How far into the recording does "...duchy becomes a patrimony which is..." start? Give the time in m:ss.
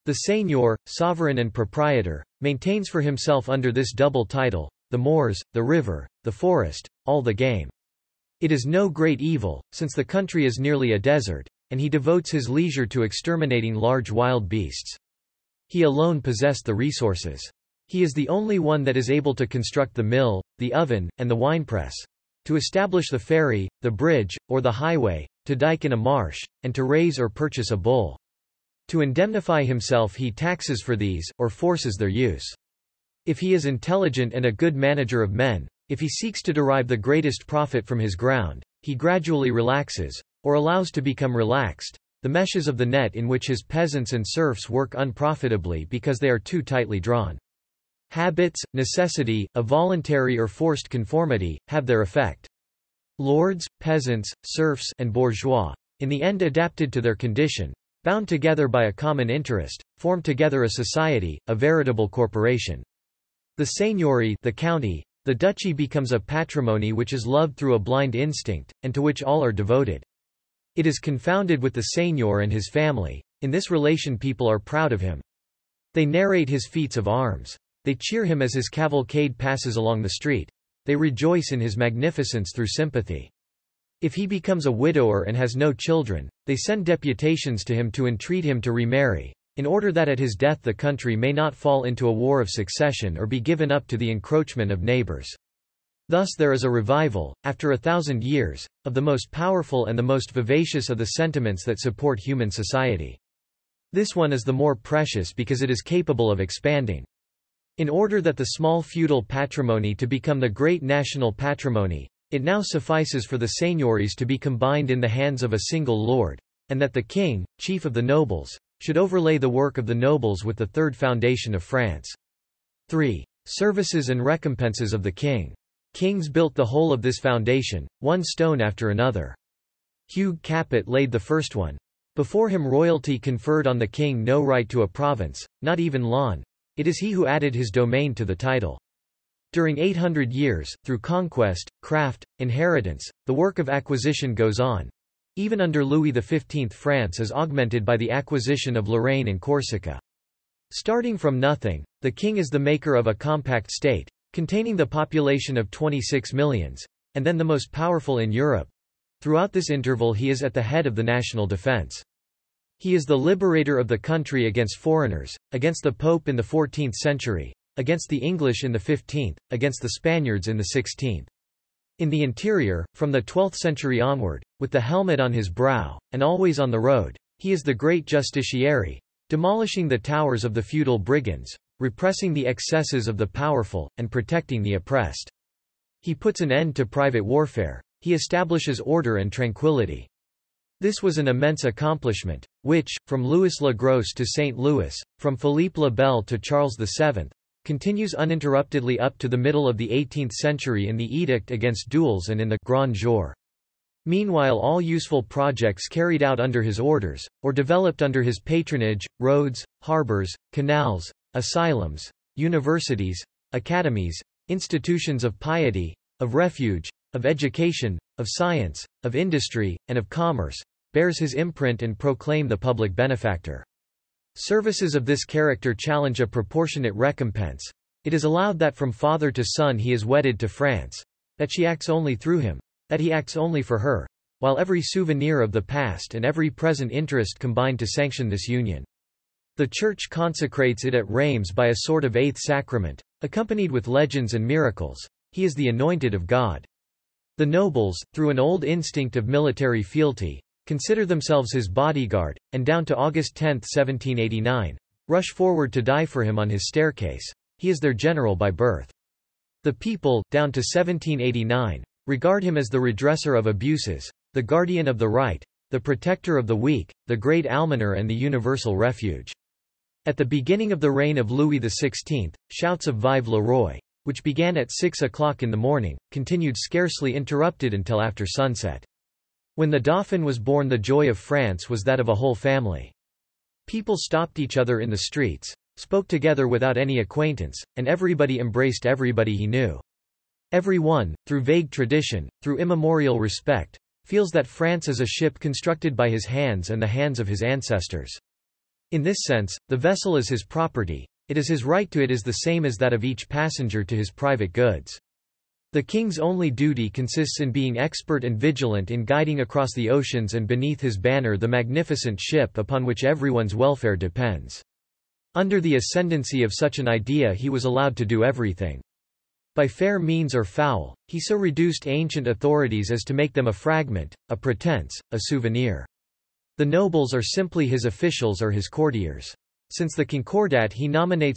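1:05.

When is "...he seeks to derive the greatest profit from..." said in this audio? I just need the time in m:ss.
0:35.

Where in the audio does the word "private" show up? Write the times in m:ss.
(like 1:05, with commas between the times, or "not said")
3:06, 5:04.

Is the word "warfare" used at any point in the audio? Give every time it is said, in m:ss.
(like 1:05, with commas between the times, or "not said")
3:07.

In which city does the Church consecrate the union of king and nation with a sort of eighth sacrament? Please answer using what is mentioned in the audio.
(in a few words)
Rheims.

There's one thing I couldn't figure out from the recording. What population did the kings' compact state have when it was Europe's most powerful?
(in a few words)
26 millions.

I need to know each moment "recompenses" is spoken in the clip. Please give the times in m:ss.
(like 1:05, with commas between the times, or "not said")
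2:04, 3:46.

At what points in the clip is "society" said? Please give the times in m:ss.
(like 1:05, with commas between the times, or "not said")
1:00, 1:42.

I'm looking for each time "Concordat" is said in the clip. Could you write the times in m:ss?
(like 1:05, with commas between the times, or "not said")
5:30.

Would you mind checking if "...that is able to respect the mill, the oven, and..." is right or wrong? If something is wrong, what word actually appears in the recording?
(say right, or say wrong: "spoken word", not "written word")
wrong: "construct", not "respect".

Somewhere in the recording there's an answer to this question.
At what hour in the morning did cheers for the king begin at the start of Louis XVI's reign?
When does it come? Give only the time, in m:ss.
4:34.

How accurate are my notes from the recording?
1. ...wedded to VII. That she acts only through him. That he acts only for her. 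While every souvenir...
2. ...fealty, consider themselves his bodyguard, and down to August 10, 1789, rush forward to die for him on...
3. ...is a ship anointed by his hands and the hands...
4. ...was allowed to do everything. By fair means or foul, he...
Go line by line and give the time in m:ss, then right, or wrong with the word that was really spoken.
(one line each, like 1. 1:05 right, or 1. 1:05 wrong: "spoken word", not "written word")
1. 3:50 wrong: "France", not "VII"
2. 4:09 right
3. 4:54 wrong: "constructed", not "anointed"
4. 5:17 right.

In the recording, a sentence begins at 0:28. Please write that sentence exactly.
To indemnify himself he taxes for these, or forces their use.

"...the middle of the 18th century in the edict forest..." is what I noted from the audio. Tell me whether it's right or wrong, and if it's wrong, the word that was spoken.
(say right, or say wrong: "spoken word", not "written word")
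wrong: "against", not "forest".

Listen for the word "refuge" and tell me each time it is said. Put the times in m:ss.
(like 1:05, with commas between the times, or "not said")
3:36, 4:28.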